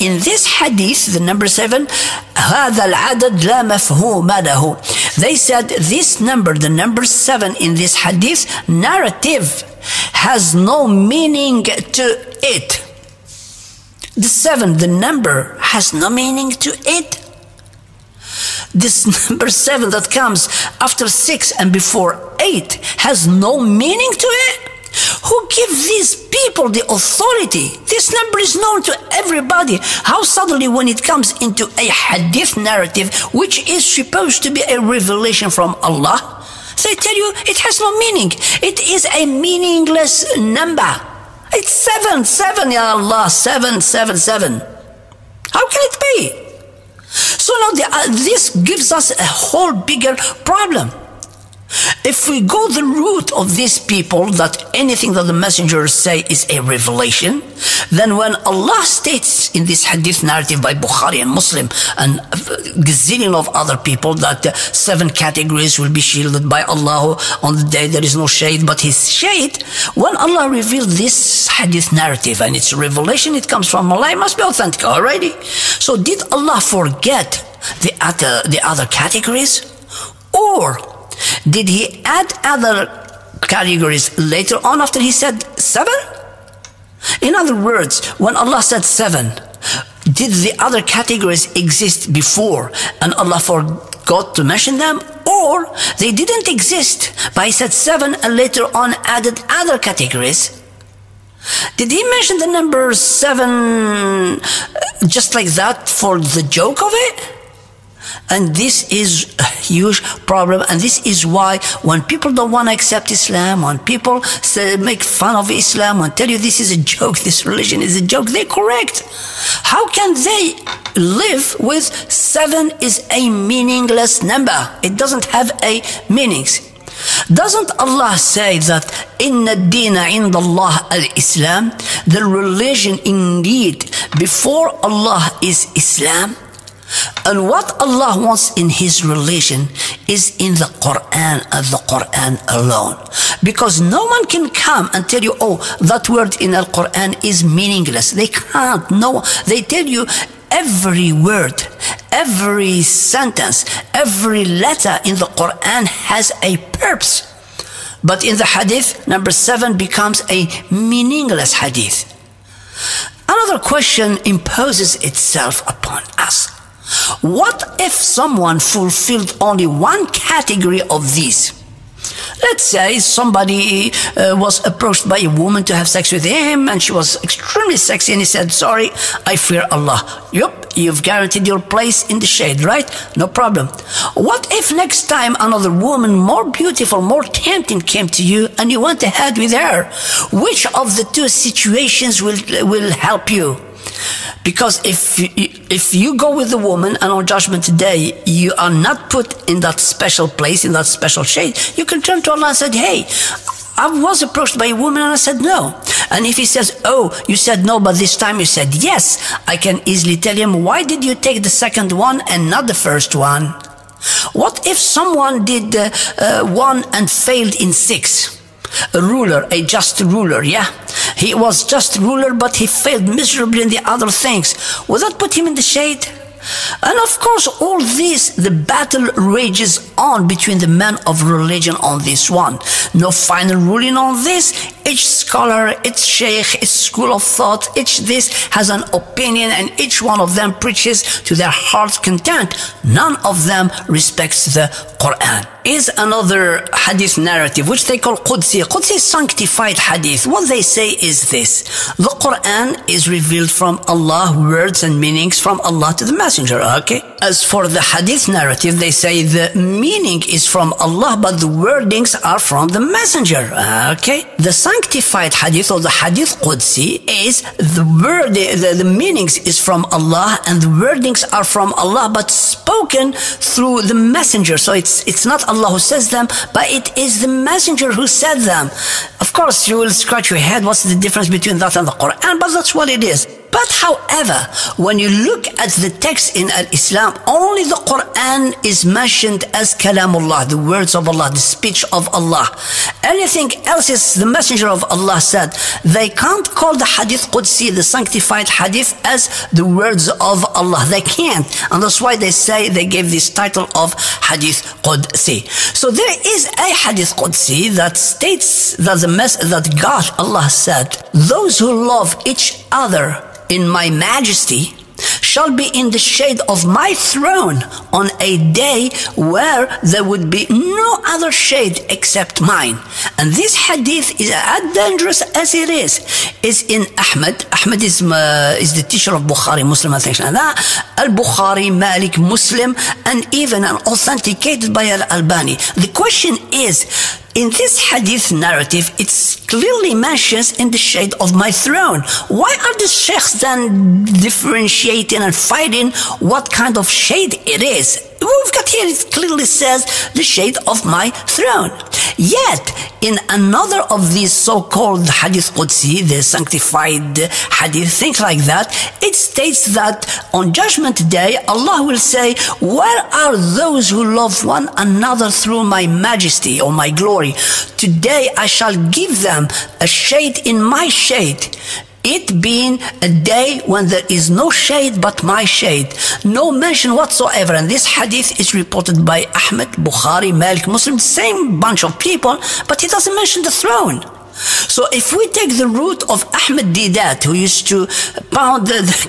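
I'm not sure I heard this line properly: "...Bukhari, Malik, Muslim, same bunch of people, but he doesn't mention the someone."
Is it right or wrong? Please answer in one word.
wrong.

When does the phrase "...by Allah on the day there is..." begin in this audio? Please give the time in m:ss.
1:06.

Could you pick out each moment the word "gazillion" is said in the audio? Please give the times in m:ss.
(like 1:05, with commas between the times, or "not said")
1:02.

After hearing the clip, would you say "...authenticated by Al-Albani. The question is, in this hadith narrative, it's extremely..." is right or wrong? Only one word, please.
wrong.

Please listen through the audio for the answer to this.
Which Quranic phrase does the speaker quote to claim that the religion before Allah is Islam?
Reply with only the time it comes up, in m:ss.
2:09.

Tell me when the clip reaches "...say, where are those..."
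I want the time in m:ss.
6:01.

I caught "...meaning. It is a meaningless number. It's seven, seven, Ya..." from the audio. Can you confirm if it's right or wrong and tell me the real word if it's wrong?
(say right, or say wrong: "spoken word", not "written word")
right.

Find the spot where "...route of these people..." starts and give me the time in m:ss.
0:52.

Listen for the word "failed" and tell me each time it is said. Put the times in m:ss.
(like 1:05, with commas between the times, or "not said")
3:37, 3:42.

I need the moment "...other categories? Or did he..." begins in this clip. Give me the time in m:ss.
1:18.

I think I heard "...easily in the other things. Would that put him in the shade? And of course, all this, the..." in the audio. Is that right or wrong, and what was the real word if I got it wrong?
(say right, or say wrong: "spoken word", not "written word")
wrong: "miserably", not "easily".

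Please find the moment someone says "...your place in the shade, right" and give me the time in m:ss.
3:01.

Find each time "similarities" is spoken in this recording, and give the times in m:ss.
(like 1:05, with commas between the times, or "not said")
not said.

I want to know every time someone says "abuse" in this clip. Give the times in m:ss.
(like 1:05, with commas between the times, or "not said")
not said.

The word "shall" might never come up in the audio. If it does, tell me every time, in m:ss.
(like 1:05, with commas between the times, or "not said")
5:15, 6:08.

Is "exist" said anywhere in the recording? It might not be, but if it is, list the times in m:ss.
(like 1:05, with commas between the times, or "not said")
1:31, 1:36.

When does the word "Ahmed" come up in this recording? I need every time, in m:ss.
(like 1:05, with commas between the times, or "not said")
6:19, 6:26.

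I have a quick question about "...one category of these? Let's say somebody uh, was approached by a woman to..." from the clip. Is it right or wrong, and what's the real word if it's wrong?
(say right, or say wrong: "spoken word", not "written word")
right.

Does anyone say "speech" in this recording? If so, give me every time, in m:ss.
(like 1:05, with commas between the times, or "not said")
4:51.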